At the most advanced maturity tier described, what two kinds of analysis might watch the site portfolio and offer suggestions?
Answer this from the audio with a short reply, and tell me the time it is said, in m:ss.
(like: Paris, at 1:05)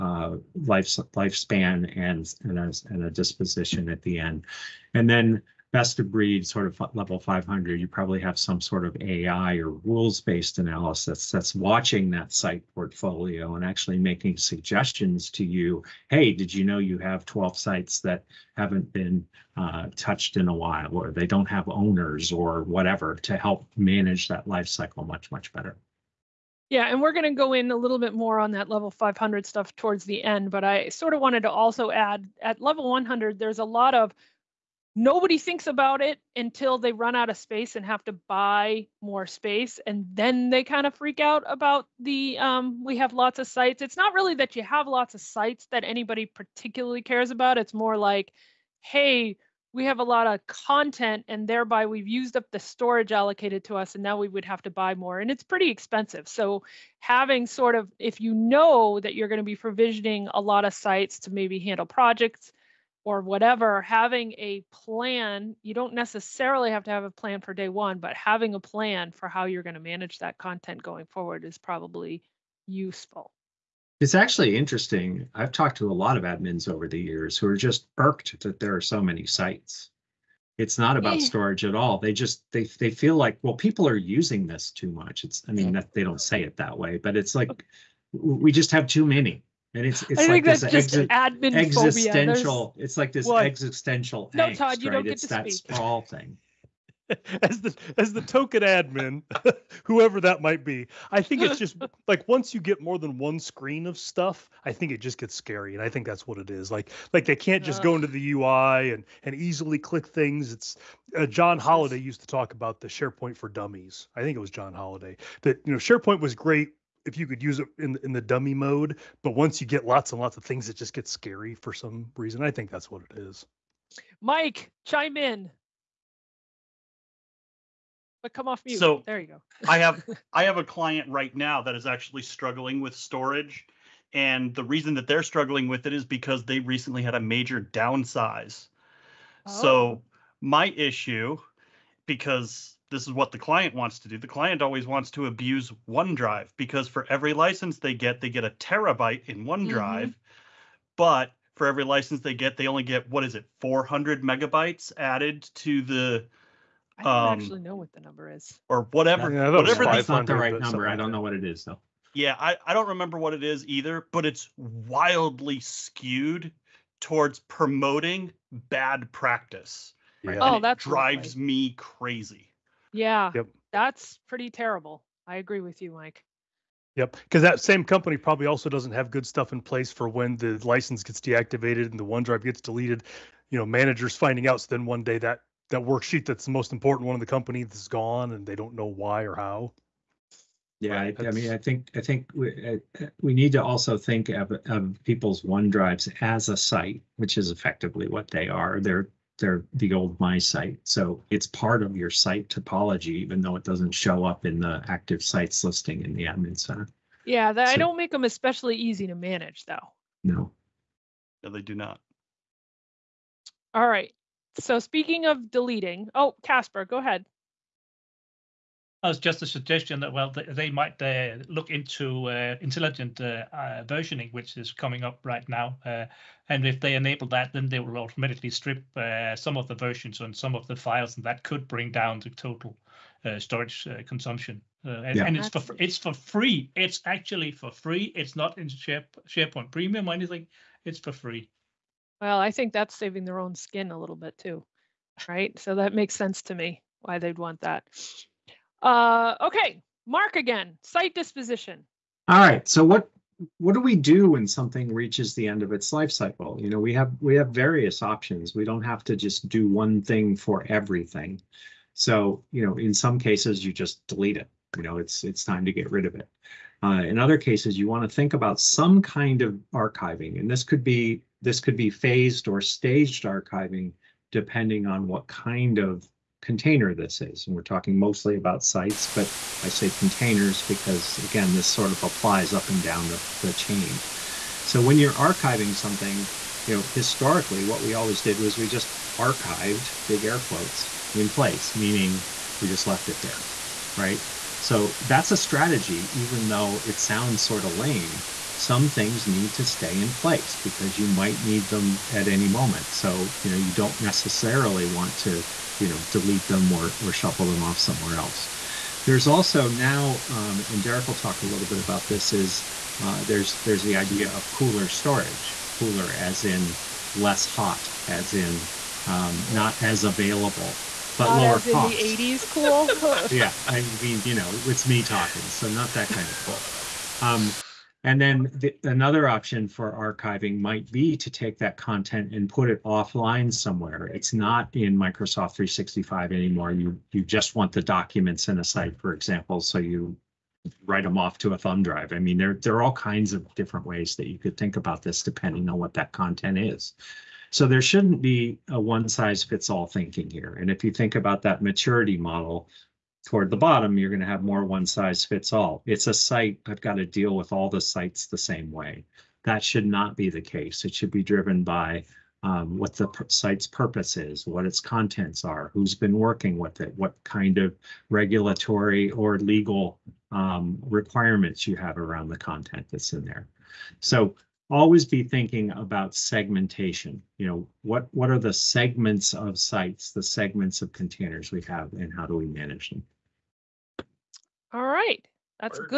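AI or rules based, at 0:09.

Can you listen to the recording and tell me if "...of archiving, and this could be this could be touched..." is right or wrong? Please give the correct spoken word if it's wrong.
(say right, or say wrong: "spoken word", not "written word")
wrong: "phased", not "touched".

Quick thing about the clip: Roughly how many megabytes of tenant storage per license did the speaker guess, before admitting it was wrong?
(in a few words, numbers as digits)
400.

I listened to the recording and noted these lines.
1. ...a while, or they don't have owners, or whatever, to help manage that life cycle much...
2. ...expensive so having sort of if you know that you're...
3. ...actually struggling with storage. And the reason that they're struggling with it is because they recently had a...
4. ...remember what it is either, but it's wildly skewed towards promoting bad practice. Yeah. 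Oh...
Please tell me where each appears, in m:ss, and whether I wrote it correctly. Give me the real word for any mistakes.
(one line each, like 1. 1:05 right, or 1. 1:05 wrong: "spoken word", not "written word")
1. 0:20 right
2. 0:55 right
3. 2:11 right
4. 2:42 right.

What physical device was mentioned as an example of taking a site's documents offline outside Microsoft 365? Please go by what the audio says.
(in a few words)
thumb drive.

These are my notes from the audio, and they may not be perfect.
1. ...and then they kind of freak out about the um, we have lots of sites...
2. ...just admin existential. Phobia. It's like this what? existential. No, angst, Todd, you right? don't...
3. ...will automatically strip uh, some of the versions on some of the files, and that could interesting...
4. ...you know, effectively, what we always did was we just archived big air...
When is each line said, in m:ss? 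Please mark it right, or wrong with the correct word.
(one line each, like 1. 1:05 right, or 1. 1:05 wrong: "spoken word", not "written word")
1. 0:39 right
2. 1:30 right
3. 3:47 wrong: "bring", not "interesting"
4. 4:46 wrong: "historically", not "effectively".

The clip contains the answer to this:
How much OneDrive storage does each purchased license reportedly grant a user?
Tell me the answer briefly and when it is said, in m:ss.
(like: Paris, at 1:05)
1 terabyte, at 2:28.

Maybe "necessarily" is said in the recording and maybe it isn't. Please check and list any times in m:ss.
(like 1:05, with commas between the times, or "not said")
1:05, 5:04.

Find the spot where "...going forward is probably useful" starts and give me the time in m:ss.
1:10.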